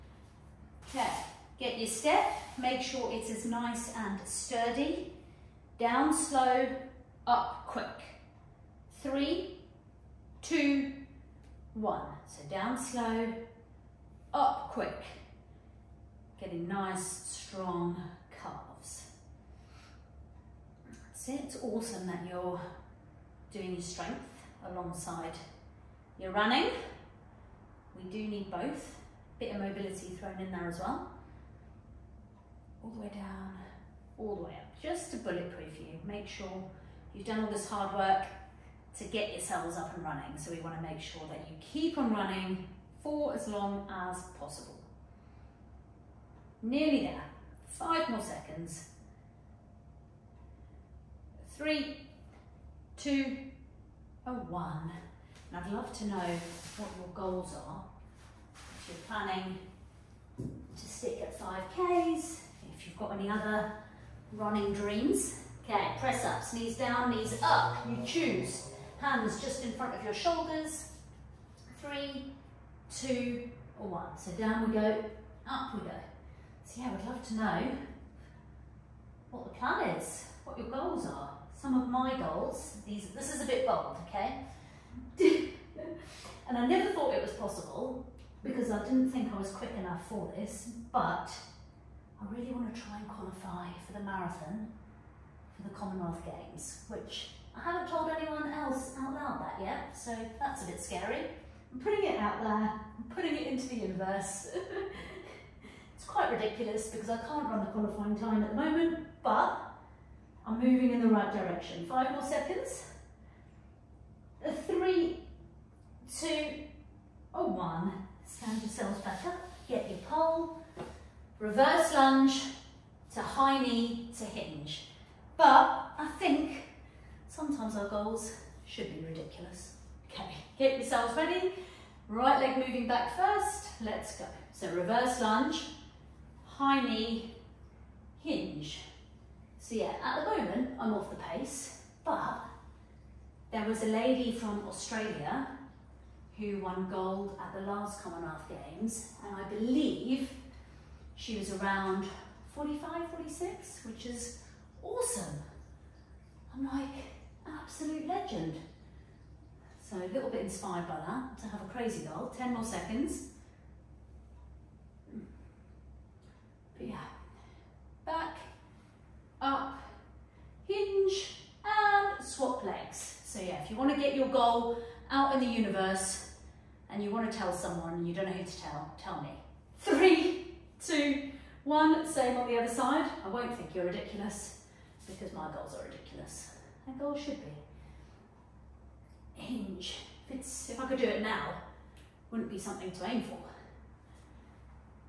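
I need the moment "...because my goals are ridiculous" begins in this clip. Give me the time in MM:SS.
03:05.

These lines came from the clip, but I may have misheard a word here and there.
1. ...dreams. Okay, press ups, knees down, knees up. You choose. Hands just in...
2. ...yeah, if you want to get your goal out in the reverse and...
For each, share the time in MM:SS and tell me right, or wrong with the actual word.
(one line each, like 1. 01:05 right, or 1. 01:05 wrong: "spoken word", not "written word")
1. 01:04 right
2. 02:53 wrong: "universe", not "reverse".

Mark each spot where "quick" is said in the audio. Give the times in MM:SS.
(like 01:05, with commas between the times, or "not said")
00:07, 00:14, 01:29.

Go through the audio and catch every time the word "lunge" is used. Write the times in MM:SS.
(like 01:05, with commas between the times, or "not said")
02:01, 02:15.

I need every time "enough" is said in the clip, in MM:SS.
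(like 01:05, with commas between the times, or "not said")
01:29.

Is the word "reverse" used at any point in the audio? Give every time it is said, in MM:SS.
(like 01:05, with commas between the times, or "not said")
02:01, 02:14.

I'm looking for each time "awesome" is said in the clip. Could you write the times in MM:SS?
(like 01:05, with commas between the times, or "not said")
00:21, 02:34.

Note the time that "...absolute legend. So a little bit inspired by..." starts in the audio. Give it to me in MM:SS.
02:37.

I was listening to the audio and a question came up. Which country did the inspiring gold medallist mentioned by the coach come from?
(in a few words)
Australia.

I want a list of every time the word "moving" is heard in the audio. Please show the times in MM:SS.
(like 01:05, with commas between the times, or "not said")
01:50, 02:12.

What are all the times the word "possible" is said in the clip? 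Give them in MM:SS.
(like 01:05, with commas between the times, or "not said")
00:44, 01:27.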